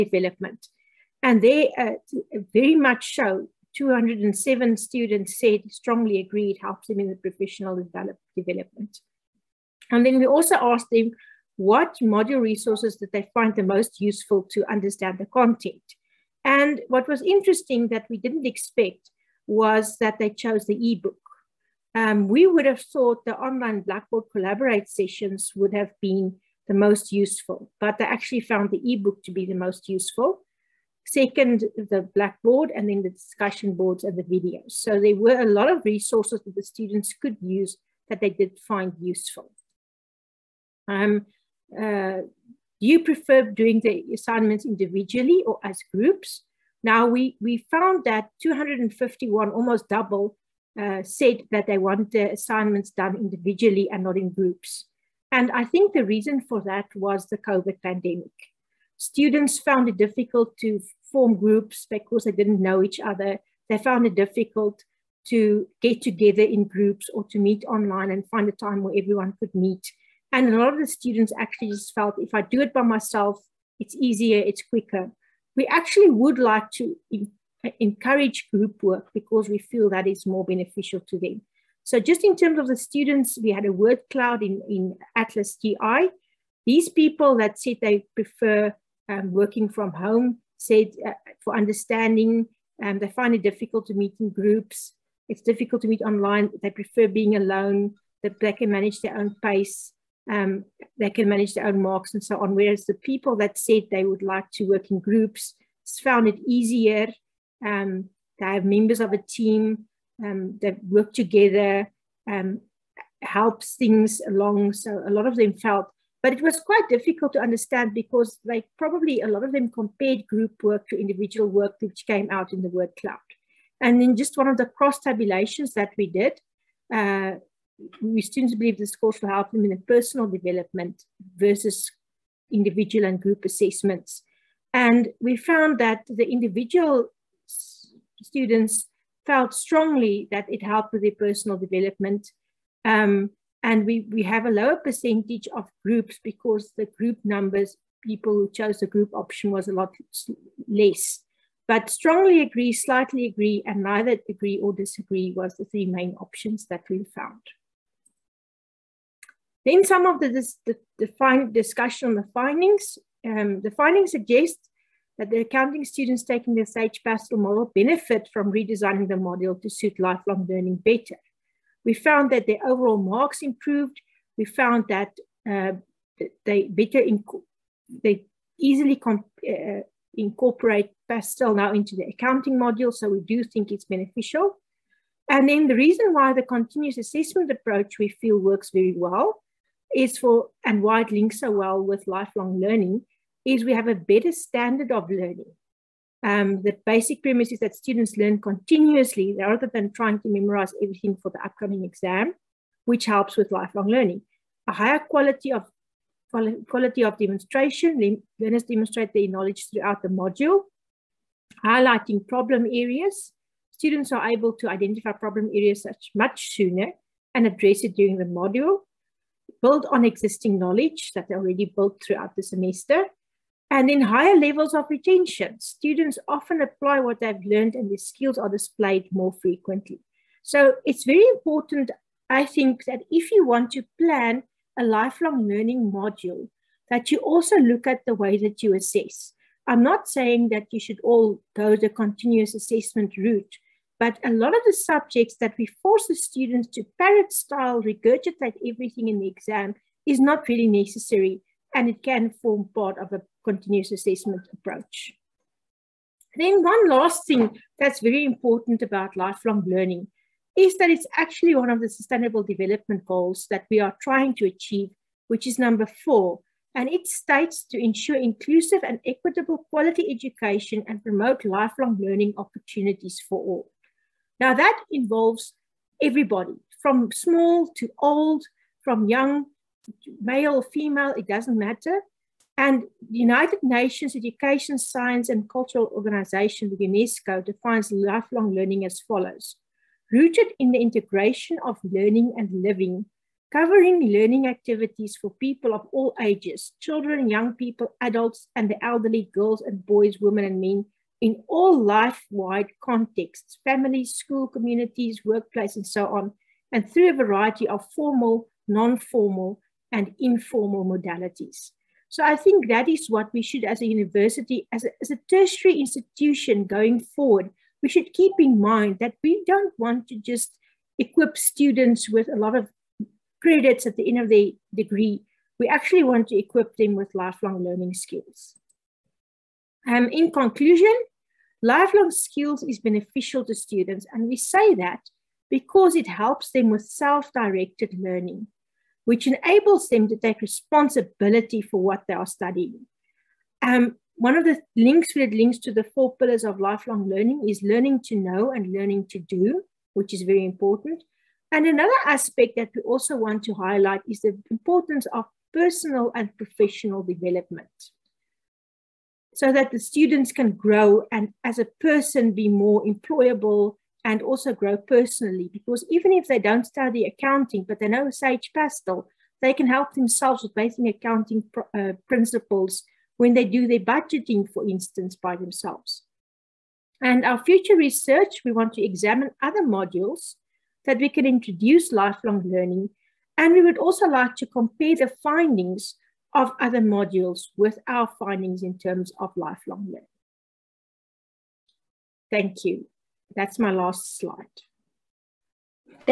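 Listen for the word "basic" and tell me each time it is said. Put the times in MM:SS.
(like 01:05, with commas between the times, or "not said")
03:16, 06:10.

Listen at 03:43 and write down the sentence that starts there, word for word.
And in higher levels of retention, students often apply what they've learned and their skills are displayed more frequently.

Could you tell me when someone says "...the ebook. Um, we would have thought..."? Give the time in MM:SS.
00:20.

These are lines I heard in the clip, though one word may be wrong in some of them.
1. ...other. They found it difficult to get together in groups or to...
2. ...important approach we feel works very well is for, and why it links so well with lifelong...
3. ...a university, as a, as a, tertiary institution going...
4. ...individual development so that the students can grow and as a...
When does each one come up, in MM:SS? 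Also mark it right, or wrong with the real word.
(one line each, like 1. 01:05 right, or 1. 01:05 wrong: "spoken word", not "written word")
1. 01:02 right
2. 03:06 wrong: "assessment", not "important"
3. 05:13 right
4. 05:56 wrong: "professional", not "individual".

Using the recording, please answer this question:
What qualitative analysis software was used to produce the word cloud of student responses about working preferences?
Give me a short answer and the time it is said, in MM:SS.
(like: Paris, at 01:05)
Atlas.ti, at 01:25.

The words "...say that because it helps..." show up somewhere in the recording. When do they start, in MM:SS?
05:34.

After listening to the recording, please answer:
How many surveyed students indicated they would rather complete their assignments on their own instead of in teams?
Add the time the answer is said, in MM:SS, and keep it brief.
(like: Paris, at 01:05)
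251, at 00:48.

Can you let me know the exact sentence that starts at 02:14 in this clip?
And we found that the individual students felt strongly that it helped with their personal development.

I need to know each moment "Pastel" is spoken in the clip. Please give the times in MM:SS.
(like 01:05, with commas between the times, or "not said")
02:47, 03:01, 06:08.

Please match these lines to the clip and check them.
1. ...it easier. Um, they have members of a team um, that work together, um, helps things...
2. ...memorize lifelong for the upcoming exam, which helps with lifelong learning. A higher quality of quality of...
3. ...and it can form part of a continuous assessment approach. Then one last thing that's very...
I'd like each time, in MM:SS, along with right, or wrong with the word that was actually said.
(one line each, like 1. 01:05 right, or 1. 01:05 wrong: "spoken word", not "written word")
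1. 01:46 right
2. 03:20 wrong: "everything", not "lifelong"
3. 04:11 right.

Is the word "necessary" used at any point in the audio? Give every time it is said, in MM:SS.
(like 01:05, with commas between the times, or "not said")
04:10.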